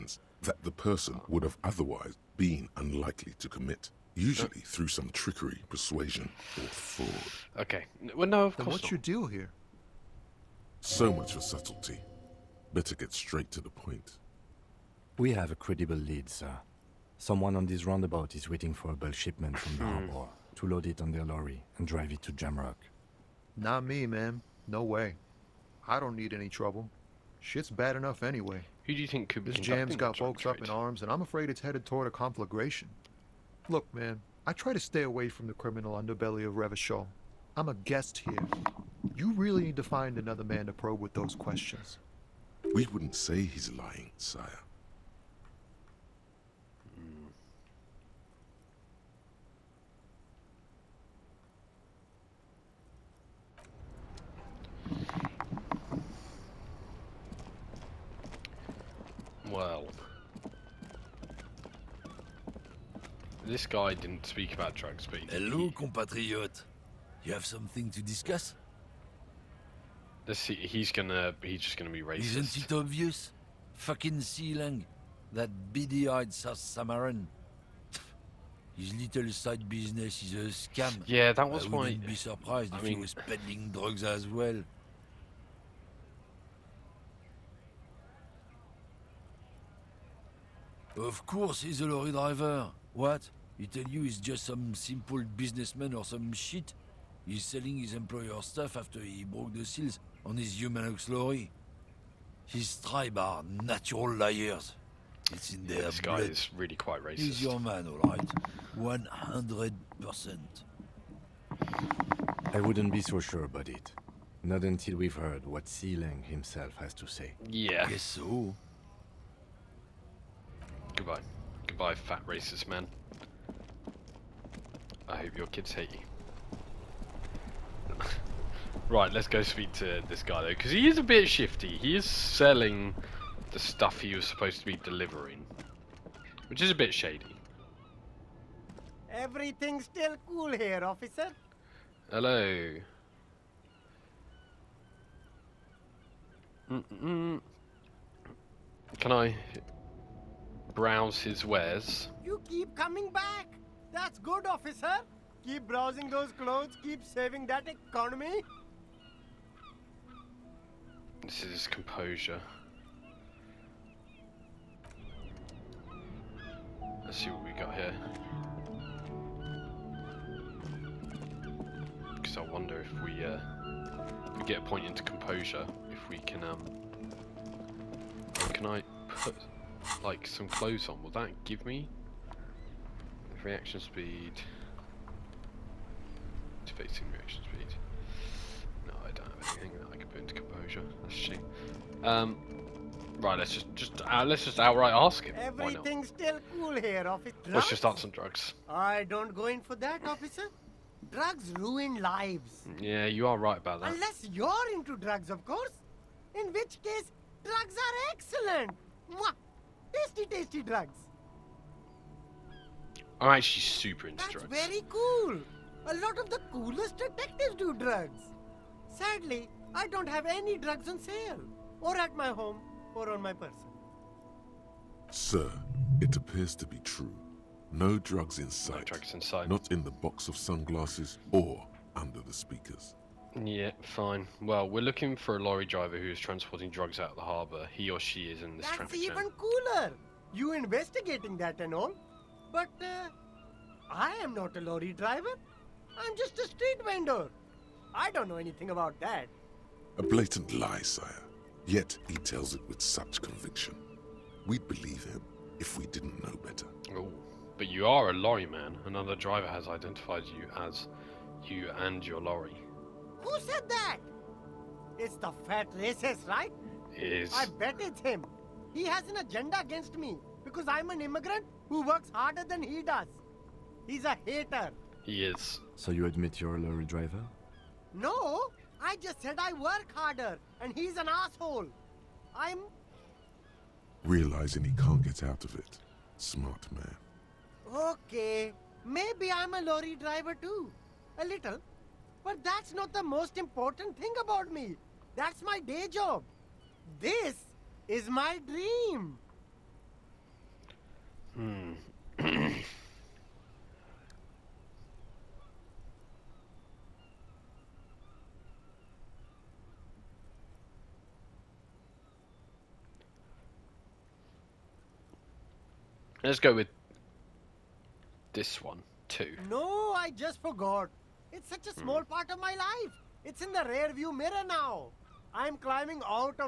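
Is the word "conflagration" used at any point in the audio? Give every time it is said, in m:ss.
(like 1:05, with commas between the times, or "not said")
0:32.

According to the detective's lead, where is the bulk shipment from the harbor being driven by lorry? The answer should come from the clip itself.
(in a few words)
Jamrock.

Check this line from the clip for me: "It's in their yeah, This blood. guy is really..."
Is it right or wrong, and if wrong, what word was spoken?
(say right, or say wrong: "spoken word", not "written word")
right.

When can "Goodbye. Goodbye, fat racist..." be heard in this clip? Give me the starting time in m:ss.
2:00.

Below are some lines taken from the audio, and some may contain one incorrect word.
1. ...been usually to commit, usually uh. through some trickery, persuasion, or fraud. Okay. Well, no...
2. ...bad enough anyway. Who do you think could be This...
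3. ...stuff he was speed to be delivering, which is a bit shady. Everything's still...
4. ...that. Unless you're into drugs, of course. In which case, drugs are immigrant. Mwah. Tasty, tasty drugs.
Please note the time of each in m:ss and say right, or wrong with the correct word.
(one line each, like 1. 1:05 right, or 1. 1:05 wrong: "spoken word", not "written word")
1. 0:02 wrong: "unlikely", not "usually"
2. 0:27 right
3. 2:13 wrong: "supposed", not "speed"
4. 3:23 wrong: "excellent", not "immigrant".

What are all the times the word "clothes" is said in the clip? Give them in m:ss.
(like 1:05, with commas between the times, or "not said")
2:36, 3:00.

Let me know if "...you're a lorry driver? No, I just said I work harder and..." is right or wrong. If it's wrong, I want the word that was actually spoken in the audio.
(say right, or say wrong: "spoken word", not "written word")
right.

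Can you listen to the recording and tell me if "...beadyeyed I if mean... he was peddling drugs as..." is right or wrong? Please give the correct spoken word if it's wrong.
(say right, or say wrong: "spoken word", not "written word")
wrong: "surprised", not "beadyeyed".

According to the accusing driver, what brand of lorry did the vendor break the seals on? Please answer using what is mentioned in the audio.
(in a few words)
Humanux.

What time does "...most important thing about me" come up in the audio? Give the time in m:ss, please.
4:53.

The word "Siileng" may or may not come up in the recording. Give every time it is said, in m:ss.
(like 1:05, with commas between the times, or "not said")
1:14, 1:55.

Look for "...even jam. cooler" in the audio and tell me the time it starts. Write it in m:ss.
3:59.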